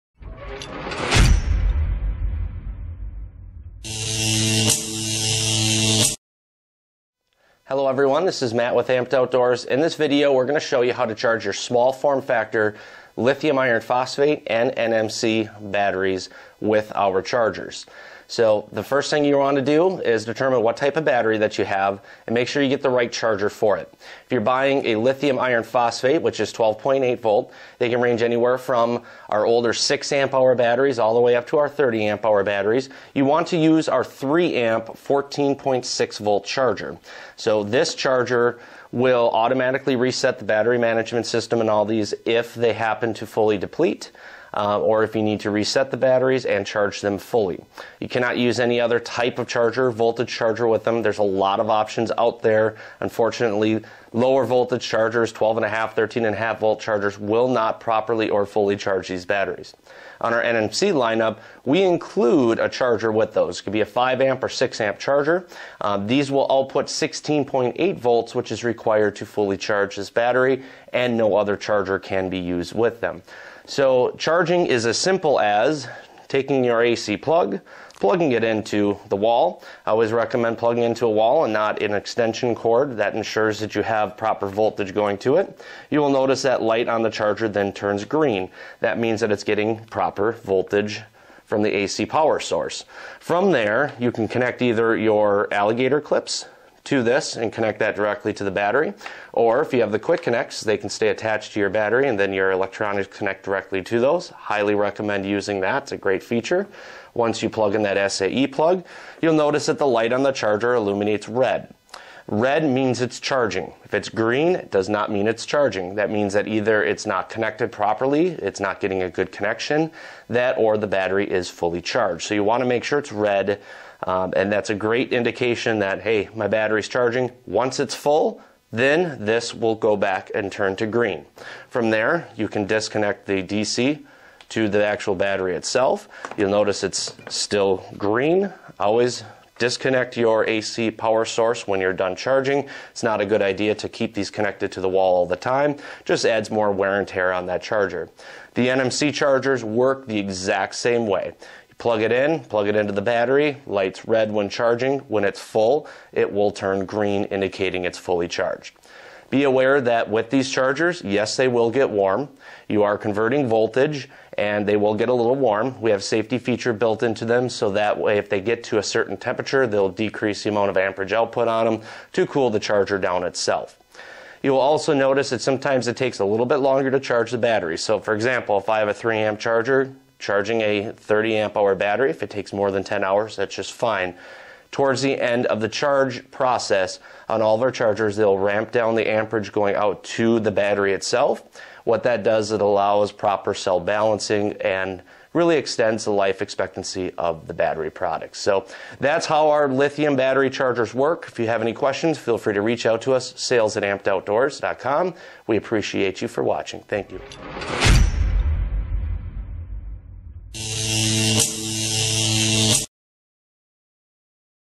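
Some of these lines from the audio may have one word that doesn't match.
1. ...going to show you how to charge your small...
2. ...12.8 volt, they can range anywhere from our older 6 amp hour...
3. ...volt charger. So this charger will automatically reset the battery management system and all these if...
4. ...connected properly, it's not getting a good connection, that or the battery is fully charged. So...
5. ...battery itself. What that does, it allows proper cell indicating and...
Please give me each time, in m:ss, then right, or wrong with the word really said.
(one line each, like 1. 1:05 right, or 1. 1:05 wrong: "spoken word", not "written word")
1. 0:10 right
2. 0:26 right
3. 0:36 right
4. 1:57 right
5. 3:10 wrong: "balancing", not "indicating".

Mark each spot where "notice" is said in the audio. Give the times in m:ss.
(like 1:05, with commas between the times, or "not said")
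1:26, 1:49, 2:16, 2:54.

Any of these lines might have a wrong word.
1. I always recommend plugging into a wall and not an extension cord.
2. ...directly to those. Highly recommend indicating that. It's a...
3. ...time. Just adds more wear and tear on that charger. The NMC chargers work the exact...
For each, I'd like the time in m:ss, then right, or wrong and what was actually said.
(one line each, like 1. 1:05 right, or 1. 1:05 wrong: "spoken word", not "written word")
1. 1:19 right
2. 1:43 wrong: "using", not "indicating"
3. 2:25 right.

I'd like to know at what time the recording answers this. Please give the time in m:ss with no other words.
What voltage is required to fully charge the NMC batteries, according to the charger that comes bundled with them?
1:06.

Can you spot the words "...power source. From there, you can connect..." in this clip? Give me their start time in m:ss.
1:32.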